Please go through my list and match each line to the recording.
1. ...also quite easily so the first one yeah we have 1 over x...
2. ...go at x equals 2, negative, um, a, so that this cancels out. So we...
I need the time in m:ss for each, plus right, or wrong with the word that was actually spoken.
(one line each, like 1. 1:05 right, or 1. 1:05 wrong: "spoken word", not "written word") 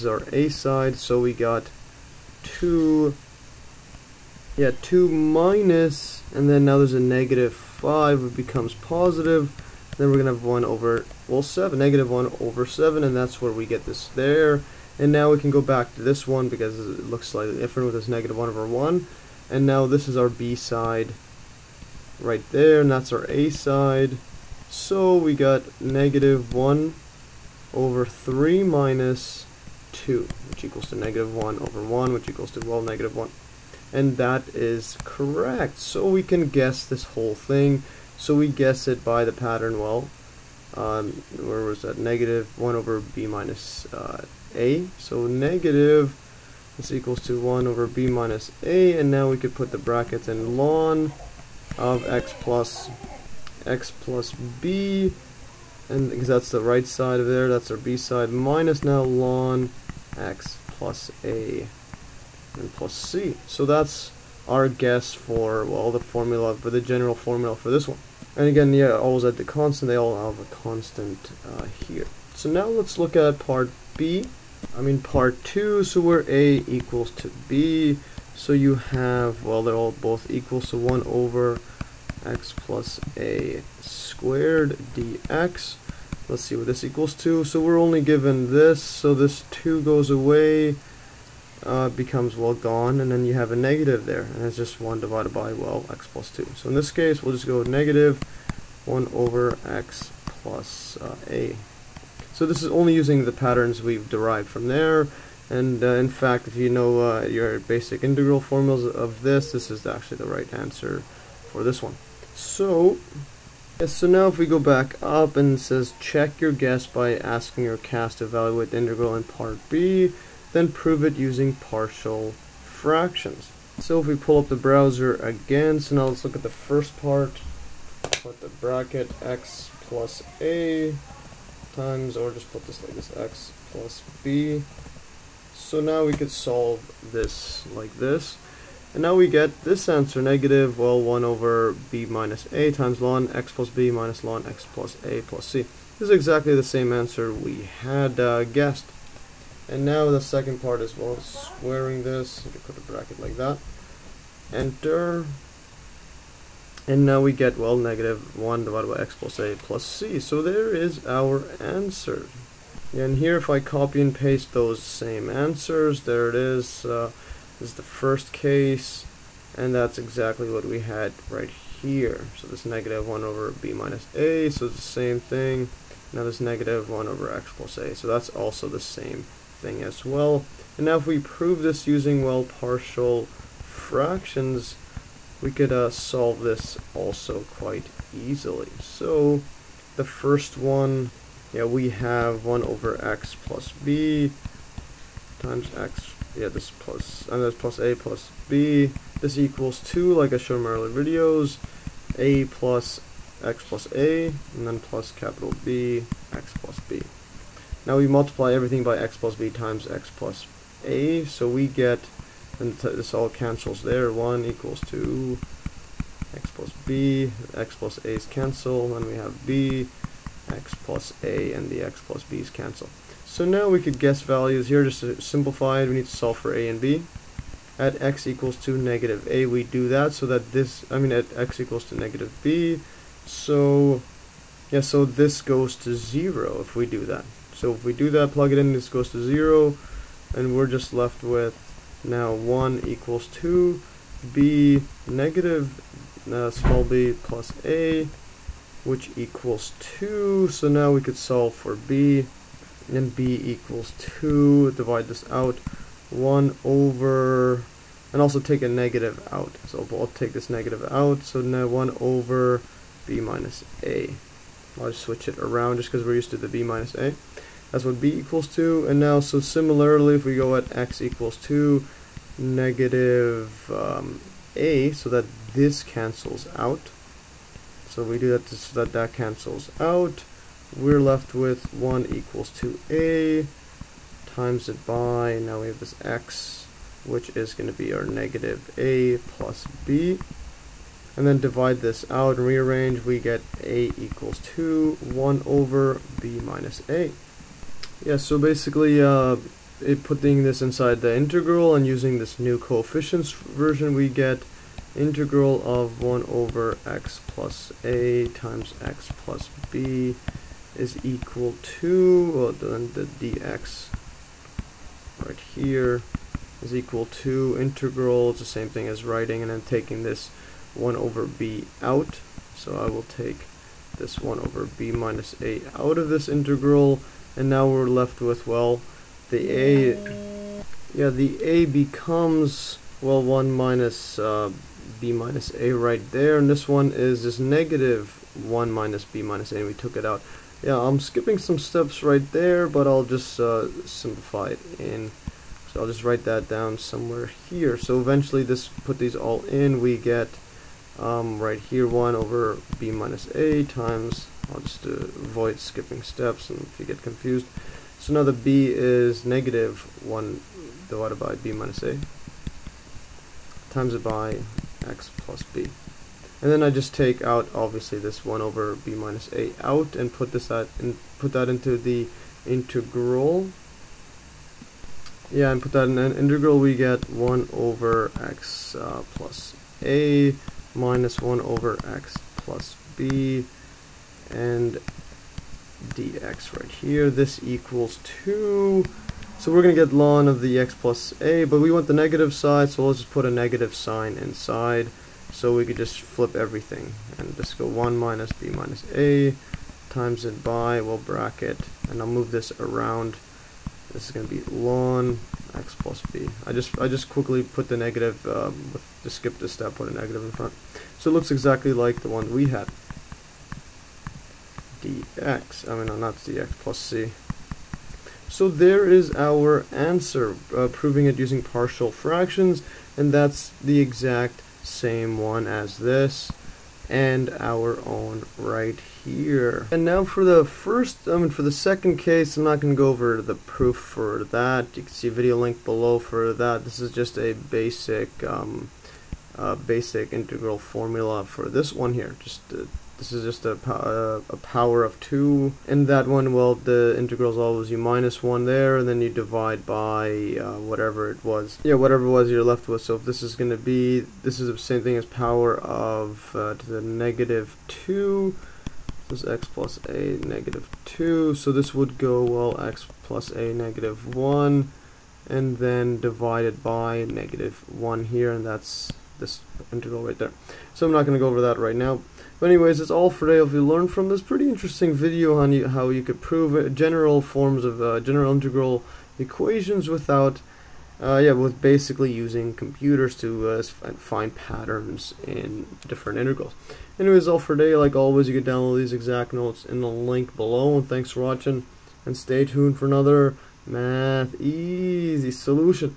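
1. 3:06 right
2. 4:30 right.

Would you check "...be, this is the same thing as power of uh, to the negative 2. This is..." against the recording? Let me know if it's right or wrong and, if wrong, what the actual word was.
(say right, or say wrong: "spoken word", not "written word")
right.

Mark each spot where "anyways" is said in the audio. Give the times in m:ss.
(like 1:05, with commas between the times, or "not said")
7:52, 8:06.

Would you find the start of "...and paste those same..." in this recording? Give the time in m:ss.
2:43.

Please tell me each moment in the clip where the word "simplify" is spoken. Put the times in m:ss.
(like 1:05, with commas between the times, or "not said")
3:45, 5:43.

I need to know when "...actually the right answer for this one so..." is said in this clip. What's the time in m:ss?
1:49.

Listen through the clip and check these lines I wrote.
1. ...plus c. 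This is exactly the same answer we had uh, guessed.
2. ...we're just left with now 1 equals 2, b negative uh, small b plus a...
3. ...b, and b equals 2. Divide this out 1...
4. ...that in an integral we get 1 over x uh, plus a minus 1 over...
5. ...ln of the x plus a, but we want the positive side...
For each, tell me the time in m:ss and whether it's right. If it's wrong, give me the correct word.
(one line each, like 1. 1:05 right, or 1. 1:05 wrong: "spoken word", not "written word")
1. 2:25 right
2. 4:00 right
3. 4:11 right
4. 6:15 right
5. 6:29 wrong: "negative", not "positive".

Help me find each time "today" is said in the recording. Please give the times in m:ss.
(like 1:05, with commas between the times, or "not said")
7:53, 8:07.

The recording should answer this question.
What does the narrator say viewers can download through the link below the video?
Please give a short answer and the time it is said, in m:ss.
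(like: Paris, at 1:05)
These exact notes, at 8:08.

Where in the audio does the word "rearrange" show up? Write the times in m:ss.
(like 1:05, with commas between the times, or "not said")
4:52.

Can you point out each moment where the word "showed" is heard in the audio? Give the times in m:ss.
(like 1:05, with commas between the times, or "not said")
3:20.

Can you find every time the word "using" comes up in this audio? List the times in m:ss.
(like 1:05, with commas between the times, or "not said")
1:42, 2:01, 3:01, 5:01, 7:01, 8:02.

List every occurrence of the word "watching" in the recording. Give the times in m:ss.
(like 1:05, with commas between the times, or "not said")
8:11.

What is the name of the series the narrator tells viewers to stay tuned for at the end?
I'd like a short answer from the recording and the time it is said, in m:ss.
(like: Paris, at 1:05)
Math Easy Solution, at 8:13.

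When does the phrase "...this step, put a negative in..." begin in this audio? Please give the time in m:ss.
6:49.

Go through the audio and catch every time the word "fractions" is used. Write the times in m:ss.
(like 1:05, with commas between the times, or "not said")
2:02, 3:03, 7:01.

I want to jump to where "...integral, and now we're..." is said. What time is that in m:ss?
5:26.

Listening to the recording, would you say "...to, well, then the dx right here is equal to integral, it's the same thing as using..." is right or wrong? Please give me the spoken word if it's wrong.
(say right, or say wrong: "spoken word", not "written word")
wrong: "writing", not "using".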